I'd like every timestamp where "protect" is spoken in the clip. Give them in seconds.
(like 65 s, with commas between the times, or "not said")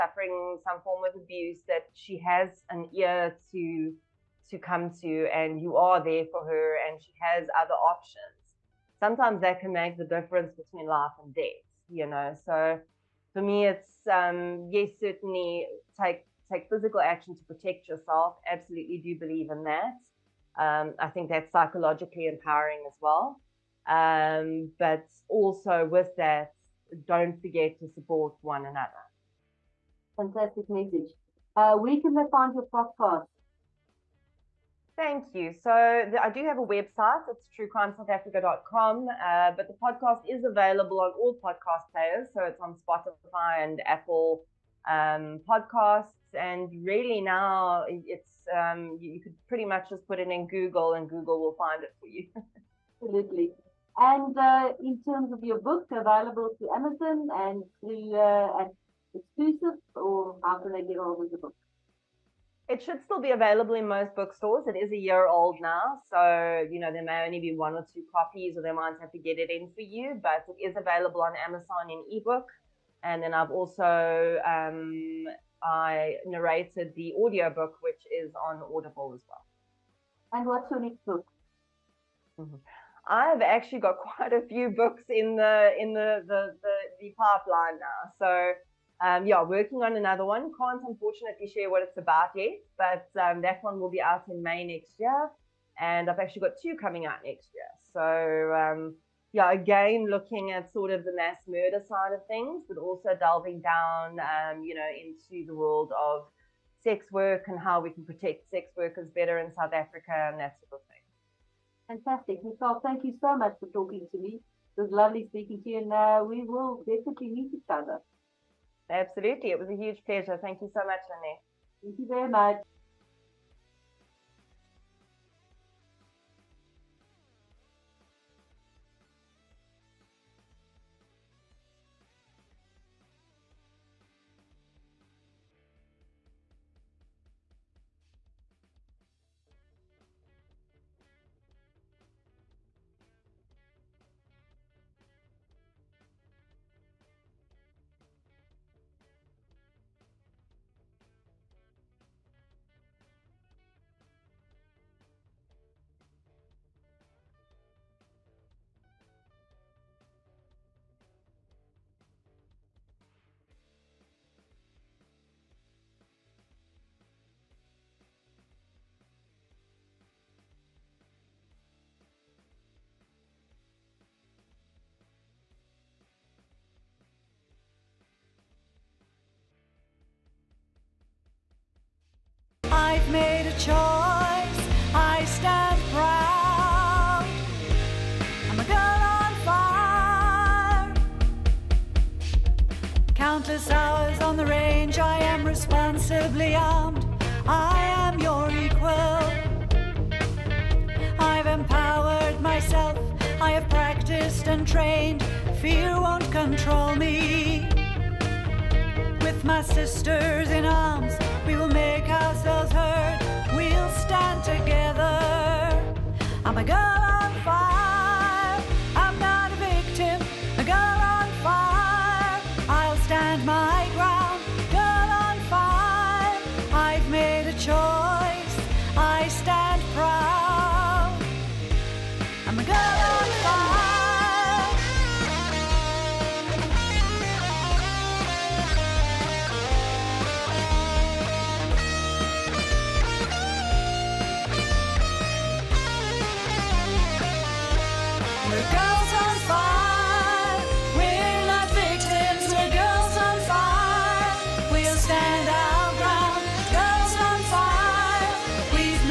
17 s, 108 s.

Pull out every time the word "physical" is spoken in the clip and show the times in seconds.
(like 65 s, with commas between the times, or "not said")
16 s.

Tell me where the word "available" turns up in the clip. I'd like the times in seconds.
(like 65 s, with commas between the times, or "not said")
40 s, 55 s, 63 s, 70 s.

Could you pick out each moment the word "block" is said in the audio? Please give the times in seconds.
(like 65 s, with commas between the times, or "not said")
not said.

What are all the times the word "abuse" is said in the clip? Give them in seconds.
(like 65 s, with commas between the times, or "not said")
1 s.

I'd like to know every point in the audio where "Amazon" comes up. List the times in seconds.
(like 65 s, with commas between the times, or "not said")
56 s, 71 s.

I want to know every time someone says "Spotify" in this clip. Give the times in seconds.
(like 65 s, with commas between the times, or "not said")
42 s.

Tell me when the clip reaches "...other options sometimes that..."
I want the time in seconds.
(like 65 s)
7 s.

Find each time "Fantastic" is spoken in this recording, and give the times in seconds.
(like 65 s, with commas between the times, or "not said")
30 s, 111 s.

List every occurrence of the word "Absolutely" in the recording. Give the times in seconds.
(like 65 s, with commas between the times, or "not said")
18 s, 53 s, 118 s.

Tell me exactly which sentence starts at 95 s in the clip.
And I've actually got two coming out next year.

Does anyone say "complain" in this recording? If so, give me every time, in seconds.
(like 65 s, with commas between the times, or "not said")
not said.